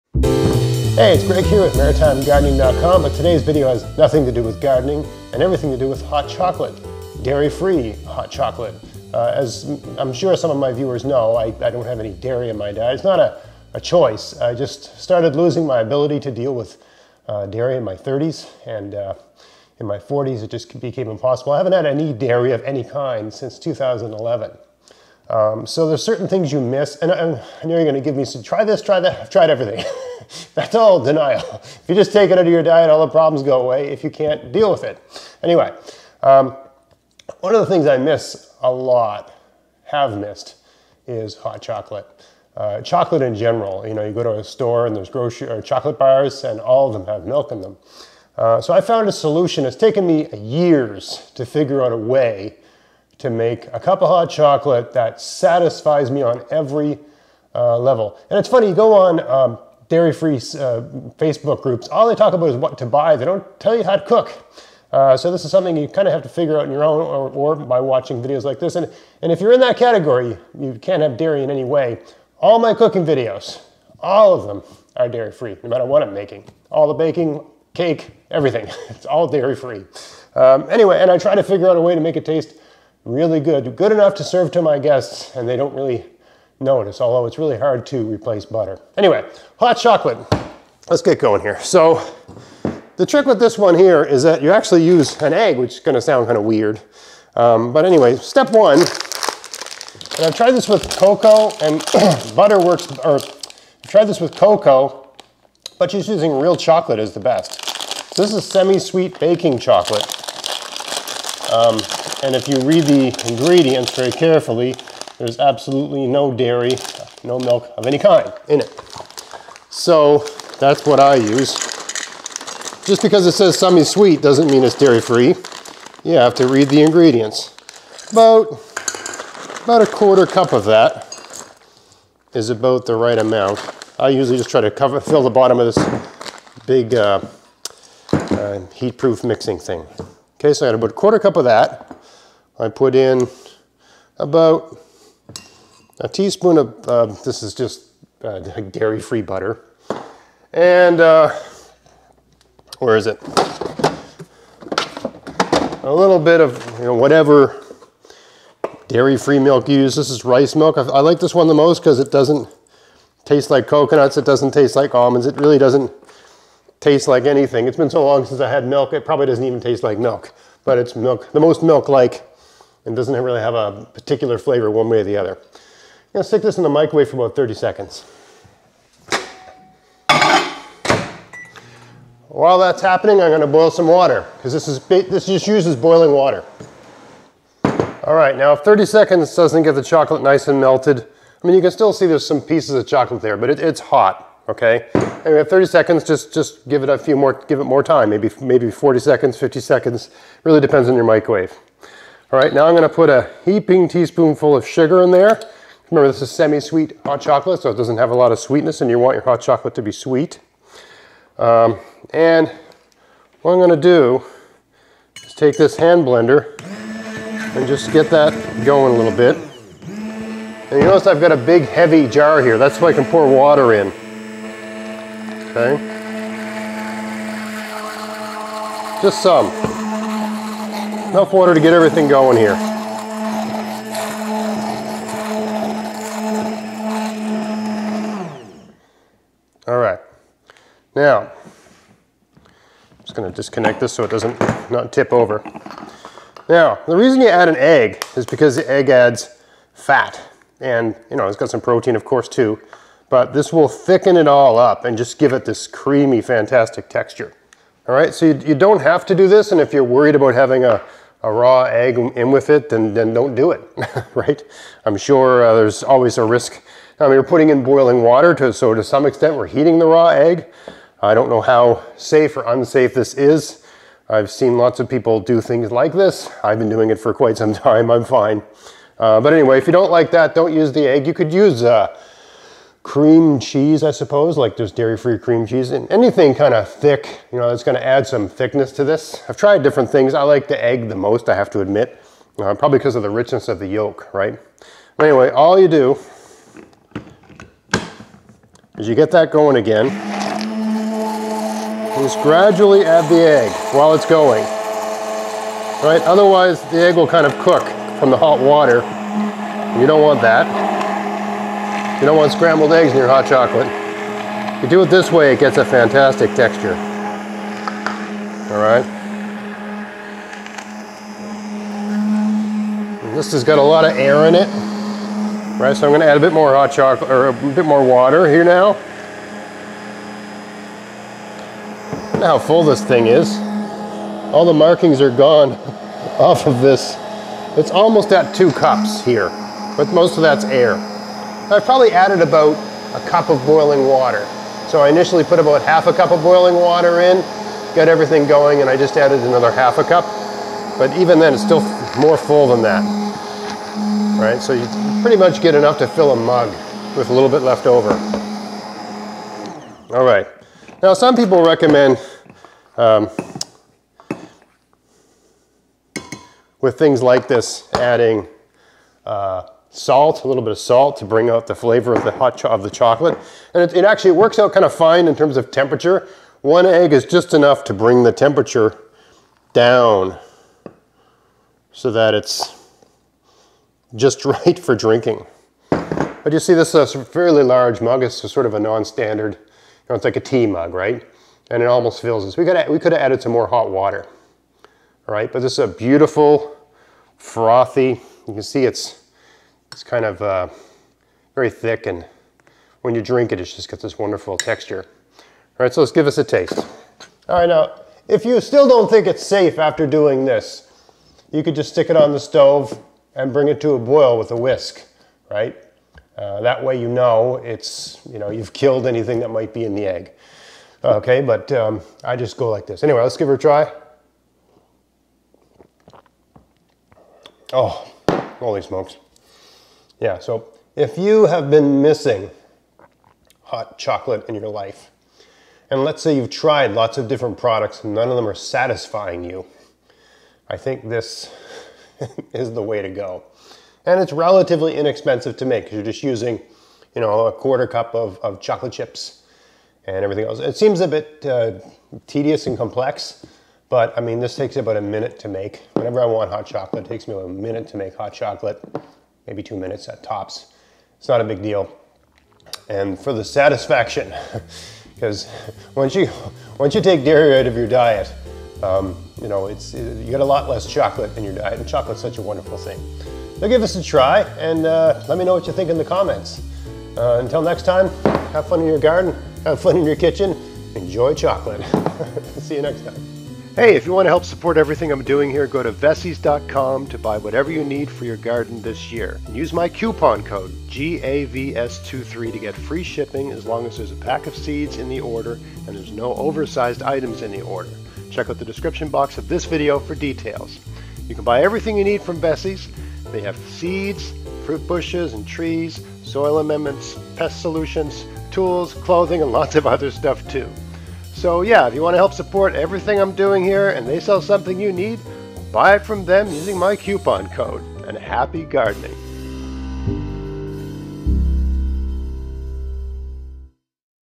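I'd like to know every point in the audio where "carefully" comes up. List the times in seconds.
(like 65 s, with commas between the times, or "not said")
114 s.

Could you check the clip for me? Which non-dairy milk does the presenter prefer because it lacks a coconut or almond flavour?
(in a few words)
rice milk.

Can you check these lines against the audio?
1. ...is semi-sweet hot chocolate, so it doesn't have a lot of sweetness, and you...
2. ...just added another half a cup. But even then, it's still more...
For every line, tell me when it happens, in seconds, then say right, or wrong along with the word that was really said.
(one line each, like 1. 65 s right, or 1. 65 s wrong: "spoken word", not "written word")
1. 206 s right
2. 348 s right.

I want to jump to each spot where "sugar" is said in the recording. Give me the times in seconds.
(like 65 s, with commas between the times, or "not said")
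204 s.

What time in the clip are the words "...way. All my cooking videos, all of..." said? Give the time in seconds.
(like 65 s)
71 s.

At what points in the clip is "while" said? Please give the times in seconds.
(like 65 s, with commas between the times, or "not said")
182 s, 303 s.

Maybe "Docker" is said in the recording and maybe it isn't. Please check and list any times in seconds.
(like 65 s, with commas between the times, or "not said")
not said.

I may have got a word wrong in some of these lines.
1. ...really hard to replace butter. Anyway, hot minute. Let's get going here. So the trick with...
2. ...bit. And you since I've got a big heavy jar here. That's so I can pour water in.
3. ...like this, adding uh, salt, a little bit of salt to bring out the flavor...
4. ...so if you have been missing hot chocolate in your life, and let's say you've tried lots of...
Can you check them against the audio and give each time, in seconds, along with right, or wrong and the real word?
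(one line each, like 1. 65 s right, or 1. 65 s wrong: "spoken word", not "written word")
1. 87 s wrong: "chocolate", not "minute"
2. 219 s wrong: "notice", not "since"
3. 367 s right
4. 430 s right.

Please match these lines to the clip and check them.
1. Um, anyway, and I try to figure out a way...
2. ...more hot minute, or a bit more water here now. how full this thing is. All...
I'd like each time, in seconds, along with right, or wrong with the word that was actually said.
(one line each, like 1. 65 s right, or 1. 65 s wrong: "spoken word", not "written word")
1. 80 s right
2. 326 s wrong: "chocolate", not "minute".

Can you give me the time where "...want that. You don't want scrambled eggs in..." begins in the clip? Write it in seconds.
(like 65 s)
310 s.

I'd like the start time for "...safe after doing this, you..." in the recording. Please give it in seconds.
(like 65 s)
409 s.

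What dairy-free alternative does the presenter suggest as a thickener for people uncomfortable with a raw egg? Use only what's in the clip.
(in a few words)
dairy-free cream cheese.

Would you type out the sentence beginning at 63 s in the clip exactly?
They don't tell you how to cook.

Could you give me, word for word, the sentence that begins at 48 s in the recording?
Uh, so I found a solution.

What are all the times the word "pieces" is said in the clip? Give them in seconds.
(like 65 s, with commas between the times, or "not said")
192 s.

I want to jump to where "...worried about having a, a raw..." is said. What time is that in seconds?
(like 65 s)
259 s.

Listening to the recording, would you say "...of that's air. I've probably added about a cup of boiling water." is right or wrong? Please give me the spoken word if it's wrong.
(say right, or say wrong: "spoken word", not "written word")
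right.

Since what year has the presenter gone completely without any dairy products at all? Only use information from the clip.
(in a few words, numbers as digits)
2011.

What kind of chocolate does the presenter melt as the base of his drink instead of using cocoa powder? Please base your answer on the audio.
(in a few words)
semi-sweet baking chocolate.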